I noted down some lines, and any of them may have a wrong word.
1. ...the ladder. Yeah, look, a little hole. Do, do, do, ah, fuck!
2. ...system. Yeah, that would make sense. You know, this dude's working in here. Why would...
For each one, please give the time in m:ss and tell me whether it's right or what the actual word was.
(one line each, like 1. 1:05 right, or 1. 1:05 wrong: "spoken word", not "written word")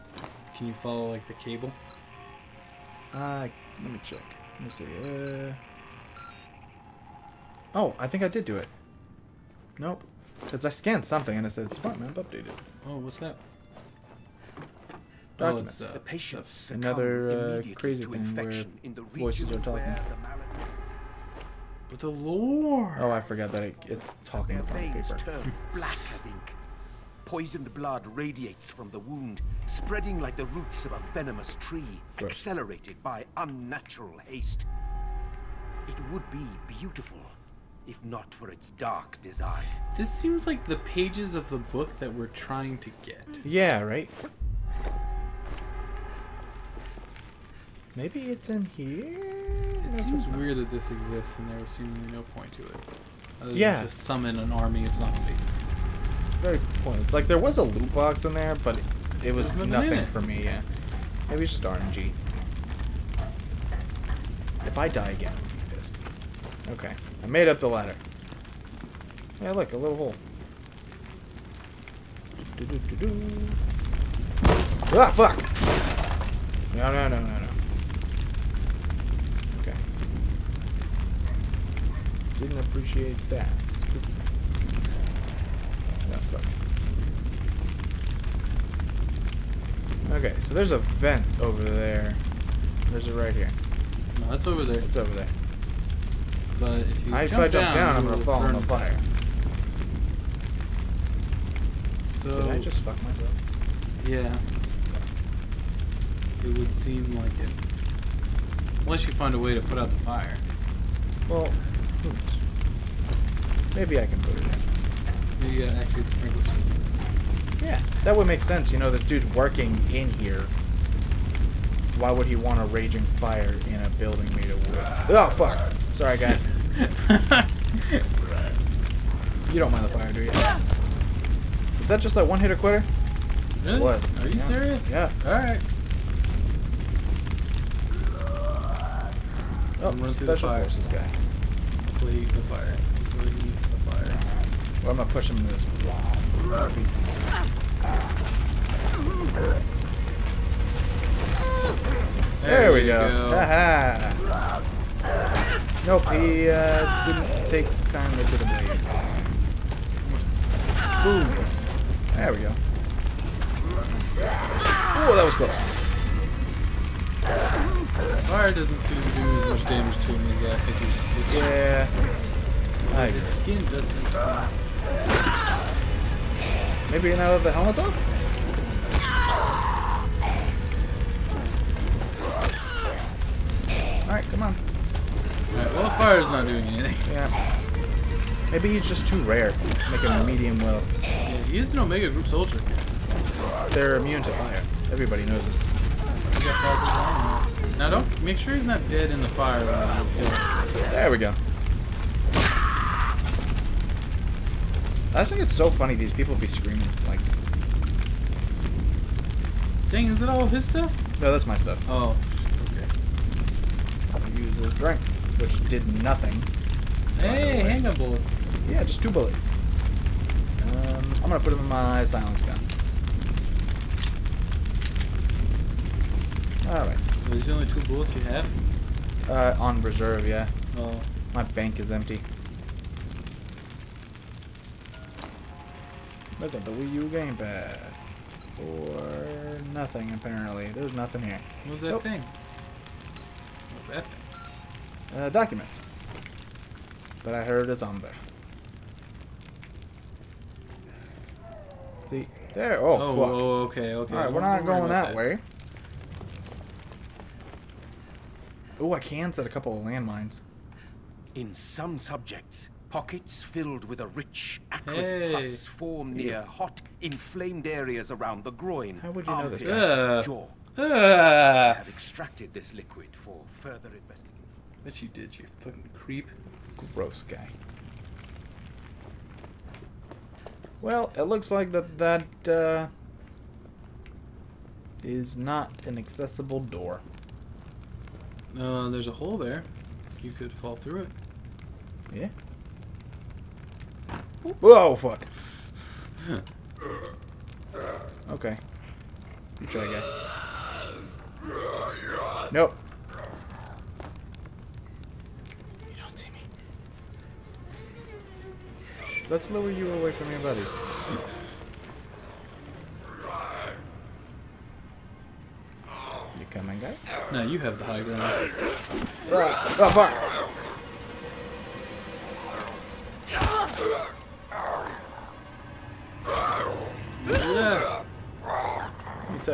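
1. 1:07 right
2. 1:56 right.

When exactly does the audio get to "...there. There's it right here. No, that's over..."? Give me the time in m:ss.
1:31.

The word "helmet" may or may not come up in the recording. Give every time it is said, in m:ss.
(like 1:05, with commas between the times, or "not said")
2:57.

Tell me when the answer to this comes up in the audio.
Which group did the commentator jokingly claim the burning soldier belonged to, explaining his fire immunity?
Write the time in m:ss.
3:11.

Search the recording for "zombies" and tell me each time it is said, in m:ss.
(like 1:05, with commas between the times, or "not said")
0:54, 4:07.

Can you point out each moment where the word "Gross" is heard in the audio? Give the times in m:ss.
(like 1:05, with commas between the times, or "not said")
0:32, 4:36.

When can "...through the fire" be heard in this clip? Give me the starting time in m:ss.
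2:20.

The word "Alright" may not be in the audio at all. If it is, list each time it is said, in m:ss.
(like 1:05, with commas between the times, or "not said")
2:15, 3:46.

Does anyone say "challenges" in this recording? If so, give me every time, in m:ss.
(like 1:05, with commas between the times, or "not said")
not said.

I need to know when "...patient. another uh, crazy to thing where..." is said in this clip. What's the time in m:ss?
0:16.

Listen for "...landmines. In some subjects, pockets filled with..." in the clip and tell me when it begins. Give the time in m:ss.
4:19.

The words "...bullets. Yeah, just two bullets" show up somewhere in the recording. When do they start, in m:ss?
3:37.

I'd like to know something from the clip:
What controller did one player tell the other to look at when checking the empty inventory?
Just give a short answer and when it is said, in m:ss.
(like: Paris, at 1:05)
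Wii U gamepad, at 3:56.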